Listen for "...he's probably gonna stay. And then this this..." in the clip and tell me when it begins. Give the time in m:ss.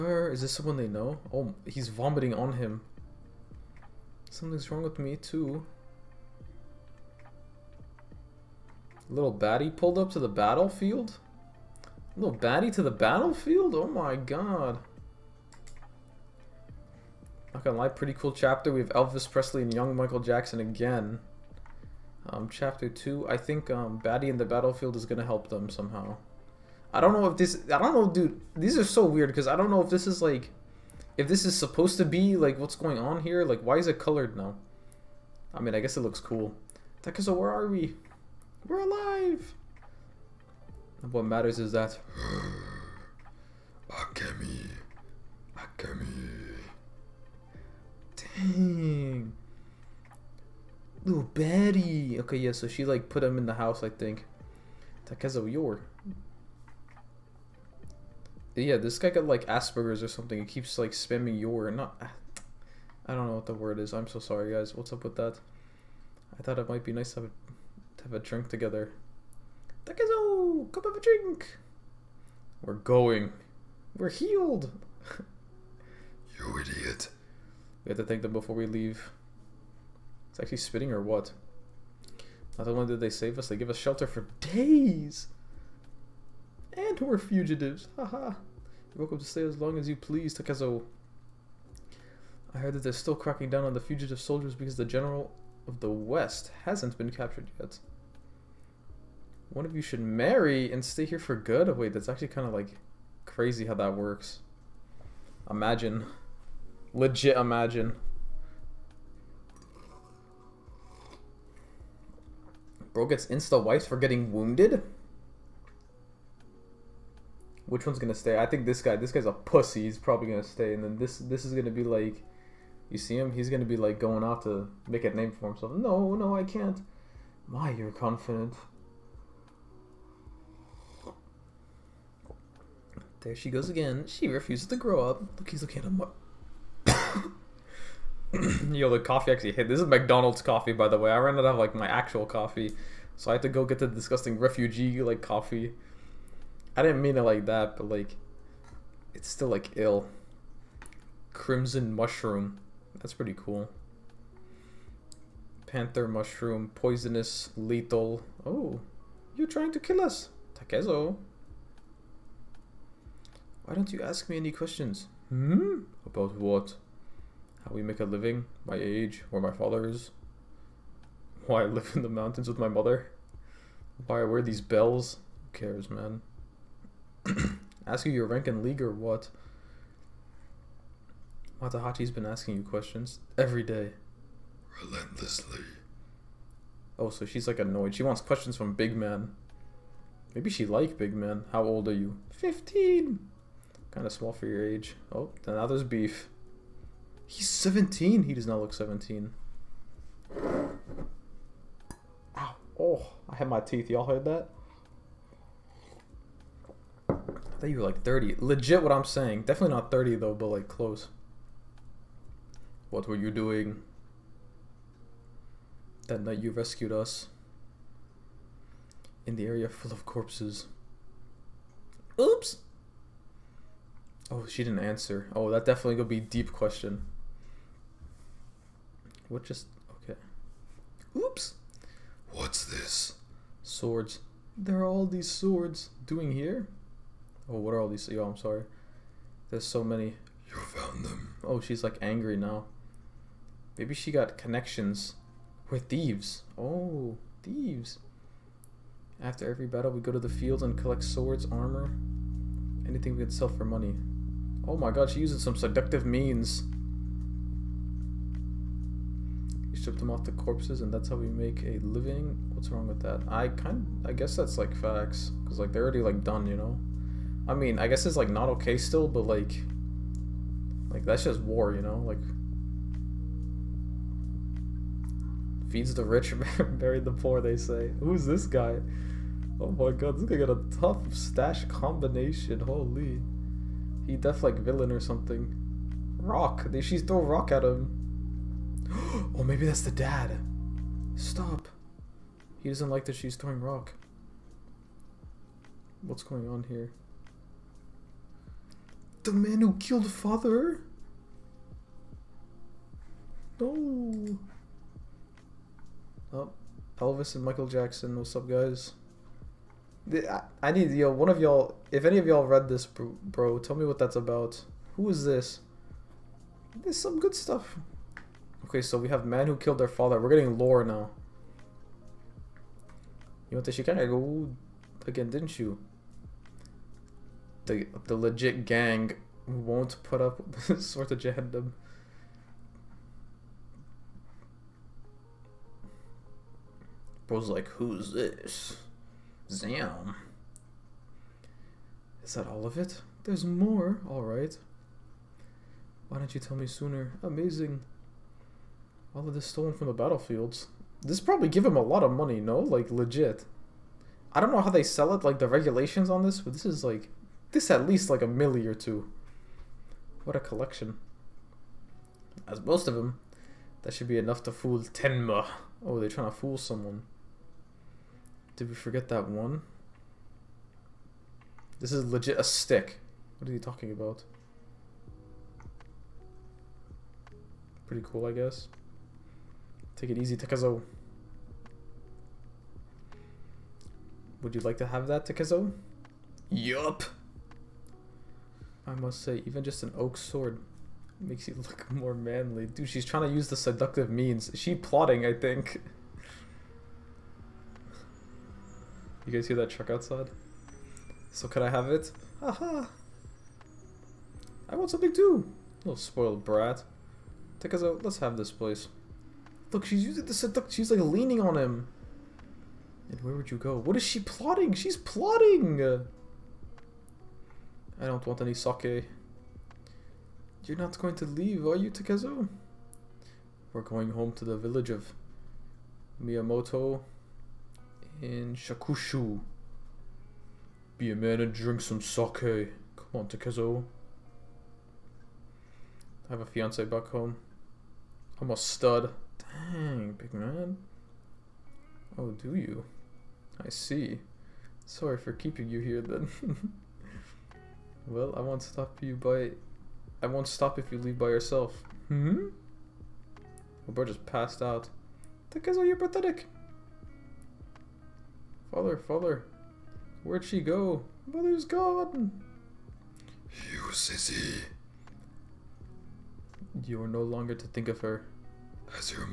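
1:59.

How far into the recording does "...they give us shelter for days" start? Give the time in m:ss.
1:23.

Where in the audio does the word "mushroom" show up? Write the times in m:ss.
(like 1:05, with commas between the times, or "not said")
2:31, 2:36.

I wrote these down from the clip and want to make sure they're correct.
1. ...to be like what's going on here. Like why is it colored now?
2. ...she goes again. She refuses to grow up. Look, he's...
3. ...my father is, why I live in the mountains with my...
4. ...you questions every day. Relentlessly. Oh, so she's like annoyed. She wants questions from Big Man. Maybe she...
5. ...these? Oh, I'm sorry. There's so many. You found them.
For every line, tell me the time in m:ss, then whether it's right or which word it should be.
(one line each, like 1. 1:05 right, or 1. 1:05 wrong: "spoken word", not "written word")
1. 0:31 right
2. 2:13 right
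3. 2:49 right
4. 3:02 right
5. 3:57 right.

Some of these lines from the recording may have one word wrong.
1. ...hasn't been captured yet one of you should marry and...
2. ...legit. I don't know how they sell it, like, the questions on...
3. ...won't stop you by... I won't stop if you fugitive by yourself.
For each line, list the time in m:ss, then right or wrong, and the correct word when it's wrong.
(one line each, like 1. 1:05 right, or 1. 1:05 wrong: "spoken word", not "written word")
1. 1:36 right
2. 5:52 wrong: "regulations", not "questions"
3. 7:28 wrong: "leave", not "fugitive".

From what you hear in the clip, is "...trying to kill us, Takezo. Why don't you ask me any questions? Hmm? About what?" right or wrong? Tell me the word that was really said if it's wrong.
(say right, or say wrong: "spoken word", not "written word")
right.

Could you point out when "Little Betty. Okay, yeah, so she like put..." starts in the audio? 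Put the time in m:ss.
0:51.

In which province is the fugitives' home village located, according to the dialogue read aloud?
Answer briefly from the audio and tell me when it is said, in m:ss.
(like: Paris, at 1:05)
Shakushu, at 7:08.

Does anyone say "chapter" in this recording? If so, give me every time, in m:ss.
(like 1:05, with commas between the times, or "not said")
0:18, 0:22.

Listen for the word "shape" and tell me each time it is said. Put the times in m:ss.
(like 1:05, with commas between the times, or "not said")
not said.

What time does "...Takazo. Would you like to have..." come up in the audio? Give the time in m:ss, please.
6:20.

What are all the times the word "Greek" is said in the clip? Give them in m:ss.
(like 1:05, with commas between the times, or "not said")
not said.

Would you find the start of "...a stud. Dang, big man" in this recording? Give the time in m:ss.
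7:18.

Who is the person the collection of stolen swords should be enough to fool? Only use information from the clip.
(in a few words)
Tenma.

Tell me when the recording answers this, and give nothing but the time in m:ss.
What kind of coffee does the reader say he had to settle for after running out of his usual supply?
2:19.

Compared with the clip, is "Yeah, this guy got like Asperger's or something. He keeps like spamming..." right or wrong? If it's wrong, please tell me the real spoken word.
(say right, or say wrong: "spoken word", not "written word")
right.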